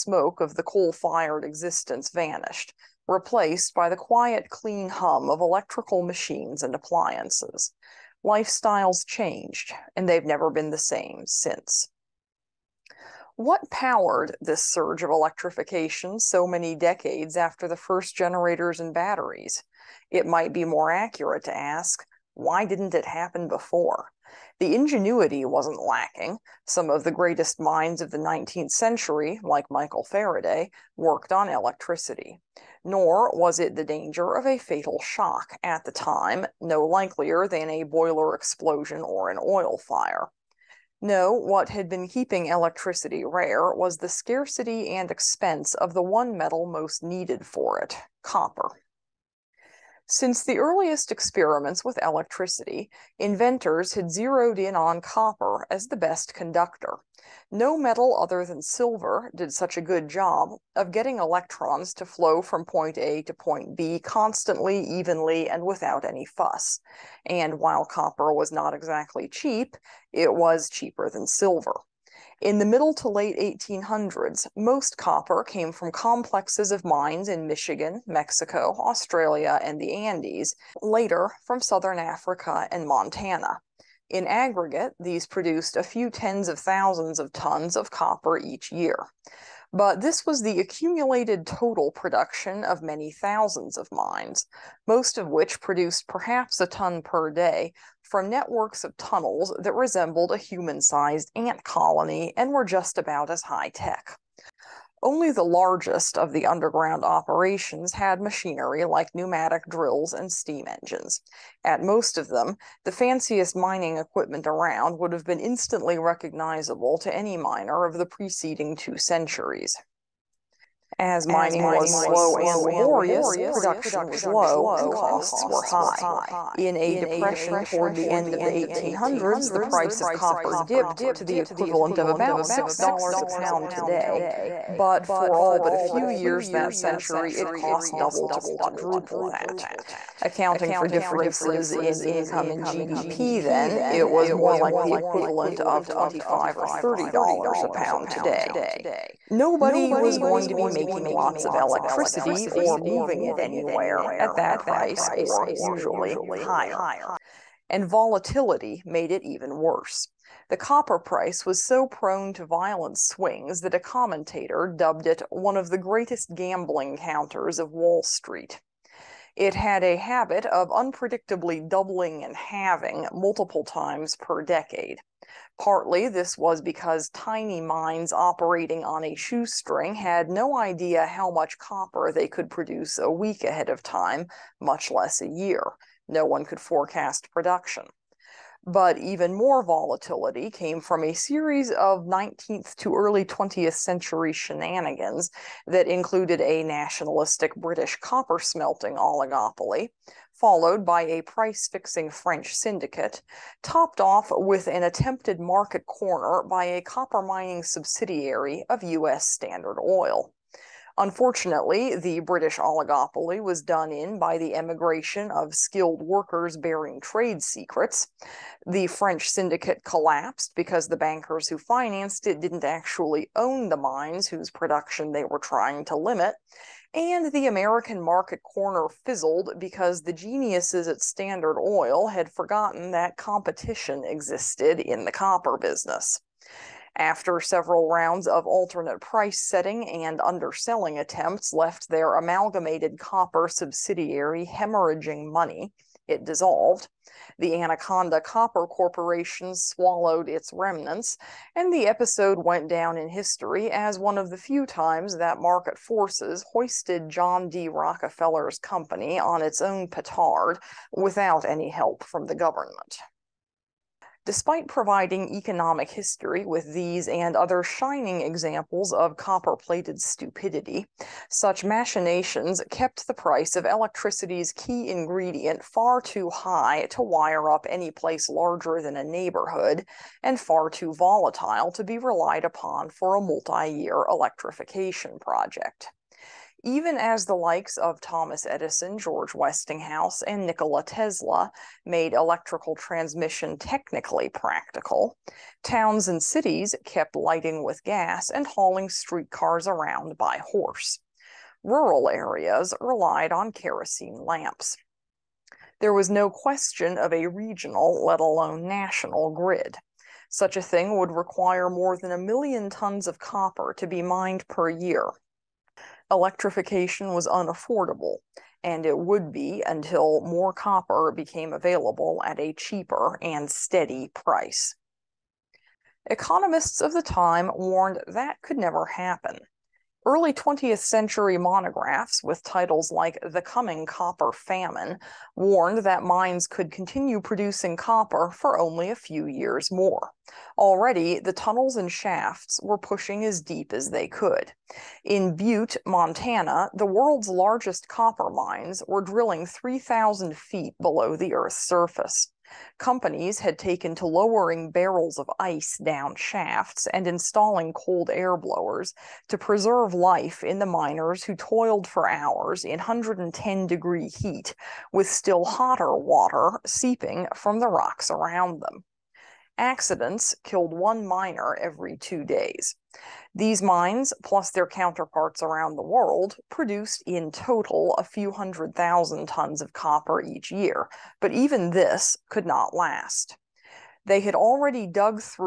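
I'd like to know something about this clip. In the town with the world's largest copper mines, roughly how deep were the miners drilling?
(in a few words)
3,000 feet.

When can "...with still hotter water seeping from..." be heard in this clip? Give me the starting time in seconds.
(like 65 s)
364 s.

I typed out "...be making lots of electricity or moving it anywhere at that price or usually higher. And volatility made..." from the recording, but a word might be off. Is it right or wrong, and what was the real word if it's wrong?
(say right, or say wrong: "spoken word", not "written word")
right.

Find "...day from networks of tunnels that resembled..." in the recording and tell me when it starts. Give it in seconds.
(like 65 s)
97 s.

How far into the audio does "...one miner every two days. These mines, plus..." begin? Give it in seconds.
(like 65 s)
370 s.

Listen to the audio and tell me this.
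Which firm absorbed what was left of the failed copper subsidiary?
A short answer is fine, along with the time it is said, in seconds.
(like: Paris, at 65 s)
Anaconda Copper Corporation, at 247 s.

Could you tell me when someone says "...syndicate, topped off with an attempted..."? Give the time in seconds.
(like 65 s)
202 s.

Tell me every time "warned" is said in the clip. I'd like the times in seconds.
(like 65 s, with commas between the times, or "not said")
327 s, 335 s.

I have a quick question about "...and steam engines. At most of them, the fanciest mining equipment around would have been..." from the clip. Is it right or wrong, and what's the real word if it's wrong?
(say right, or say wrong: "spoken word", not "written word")
right.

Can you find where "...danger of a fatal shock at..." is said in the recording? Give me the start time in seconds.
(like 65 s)
33 s.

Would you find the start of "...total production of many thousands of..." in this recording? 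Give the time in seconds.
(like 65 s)
91 s.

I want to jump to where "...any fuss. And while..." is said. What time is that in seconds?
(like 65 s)
66 s.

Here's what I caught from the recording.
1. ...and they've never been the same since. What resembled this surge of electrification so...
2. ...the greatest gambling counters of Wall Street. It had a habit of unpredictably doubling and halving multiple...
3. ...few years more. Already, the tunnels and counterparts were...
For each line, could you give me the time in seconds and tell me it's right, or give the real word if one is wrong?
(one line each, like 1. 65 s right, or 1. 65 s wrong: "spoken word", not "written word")
1. 9 s wrong: "powered", not "resembled"
2. 165 s right
3. 338 s wrong: "shafts", not "counterparts".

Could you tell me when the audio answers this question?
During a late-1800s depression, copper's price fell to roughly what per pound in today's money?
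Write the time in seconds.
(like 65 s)
132 s.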